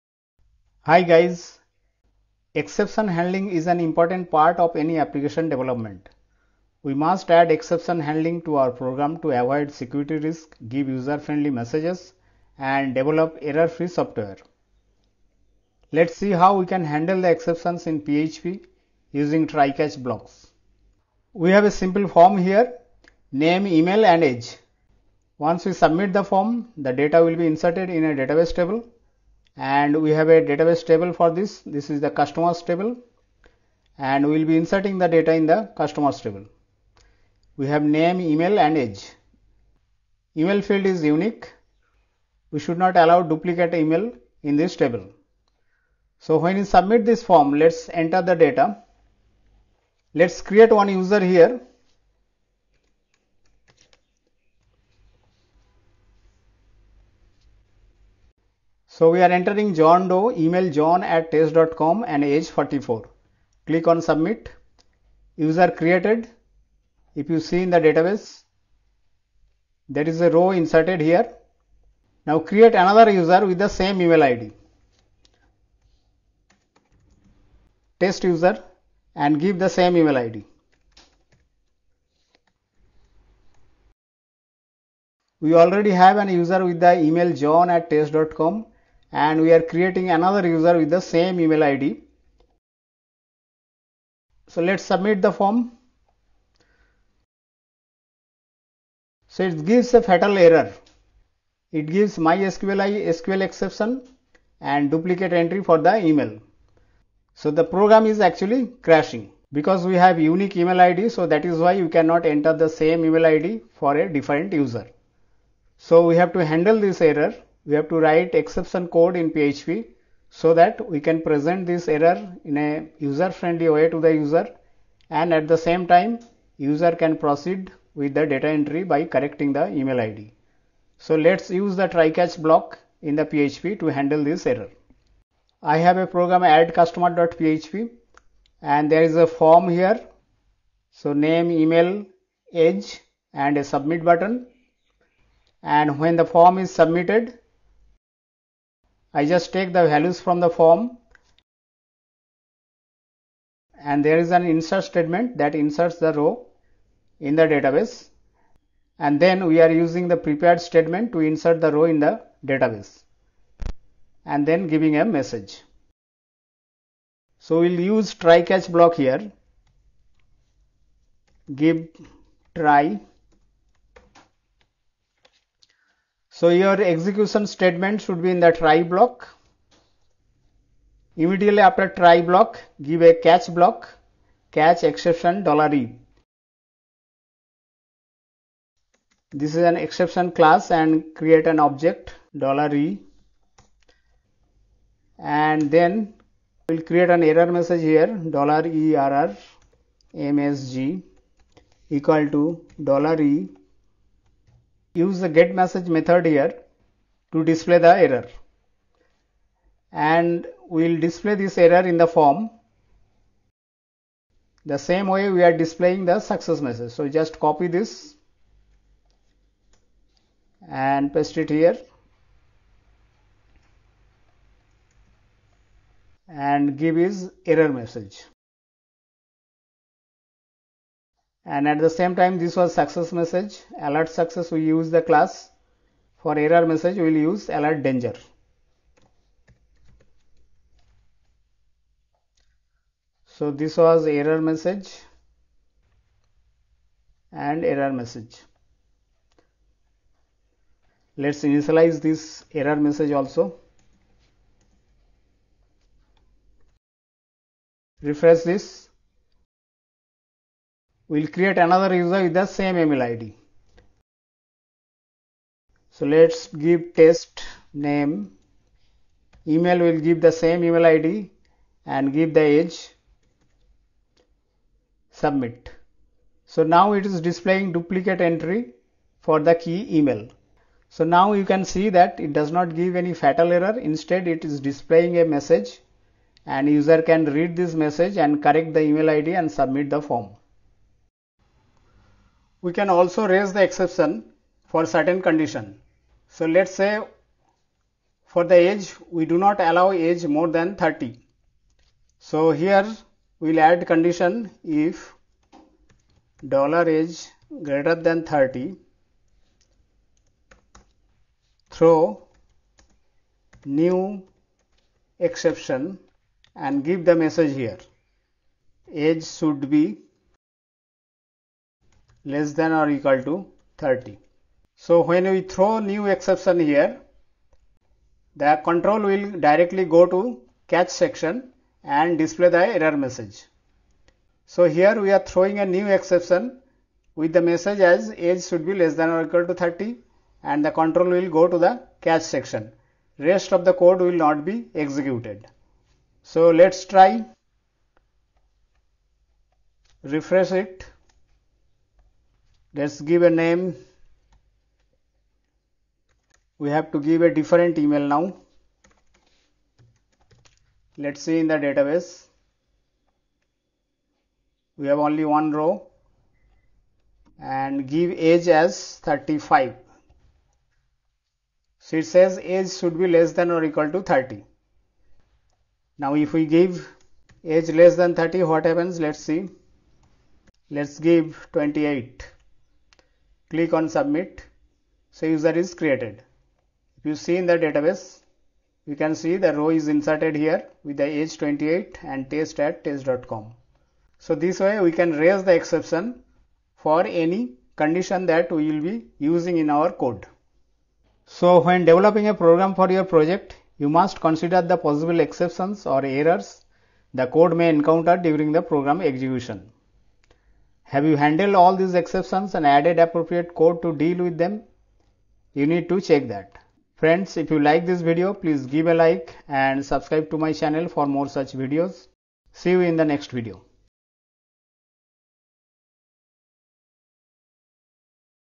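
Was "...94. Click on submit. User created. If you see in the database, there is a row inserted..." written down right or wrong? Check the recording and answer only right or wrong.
wrong.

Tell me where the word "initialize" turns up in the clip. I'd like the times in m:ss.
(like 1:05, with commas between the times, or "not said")
4:11.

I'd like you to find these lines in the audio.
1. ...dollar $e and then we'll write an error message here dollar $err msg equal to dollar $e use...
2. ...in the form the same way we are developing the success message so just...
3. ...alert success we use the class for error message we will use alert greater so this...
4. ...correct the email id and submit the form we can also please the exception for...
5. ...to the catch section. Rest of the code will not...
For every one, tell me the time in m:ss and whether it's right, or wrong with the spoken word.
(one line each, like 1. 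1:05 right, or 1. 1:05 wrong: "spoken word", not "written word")
1. 3:12 wrong: "create", not "write"
2. 3:31 wrong: "displaying", not "developing"
3. 3:53 wrong: "danger", not "greater"
4. 4:48 wrong: "raise", not "please"
5. 5:41 right.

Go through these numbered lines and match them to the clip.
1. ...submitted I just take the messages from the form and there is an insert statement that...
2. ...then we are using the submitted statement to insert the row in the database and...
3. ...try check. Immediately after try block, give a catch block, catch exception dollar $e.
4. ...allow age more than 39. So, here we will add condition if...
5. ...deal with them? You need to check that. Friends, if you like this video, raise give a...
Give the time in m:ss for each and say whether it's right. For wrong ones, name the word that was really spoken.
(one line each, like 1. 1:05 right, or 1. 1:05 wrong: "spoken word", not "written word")
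1. 2:26 wrong: "values", not "messages"
2. 2:39 wrong: "prepared", not "submitted"
3. 2:58 wrong: "block", not "check"
4. 4:59 wrong: "30", not "39"
5. 6:53 wrong: "please", not "raise".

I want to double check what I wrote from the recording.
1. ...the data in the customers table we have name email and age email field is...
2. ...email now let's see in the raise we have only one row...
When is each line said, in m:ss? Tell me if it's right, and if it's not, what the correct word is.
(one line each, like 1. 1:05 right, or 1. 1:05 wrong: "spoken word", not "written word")
1. 0:34 right
2. 5:57 wrong: "database", not "raise".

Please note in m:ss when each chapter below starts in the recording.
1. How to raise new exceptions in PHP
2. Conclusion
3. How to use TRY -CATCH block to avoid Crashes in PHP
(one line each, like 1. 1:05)
1. 4:50
2. 6:40
3. 0:20.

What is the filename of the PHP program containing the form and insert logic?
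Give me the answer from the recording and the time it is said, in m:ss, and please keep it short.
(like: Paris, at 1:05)
add_customer.php, at 2:16.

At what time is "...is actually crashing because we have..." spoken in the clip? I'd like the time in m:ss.
1:48.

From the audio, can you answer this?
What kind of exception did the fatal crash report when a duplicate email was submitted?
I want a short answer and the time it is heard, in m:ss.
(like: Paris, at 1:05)
mysqli SQL exception, at 1:42.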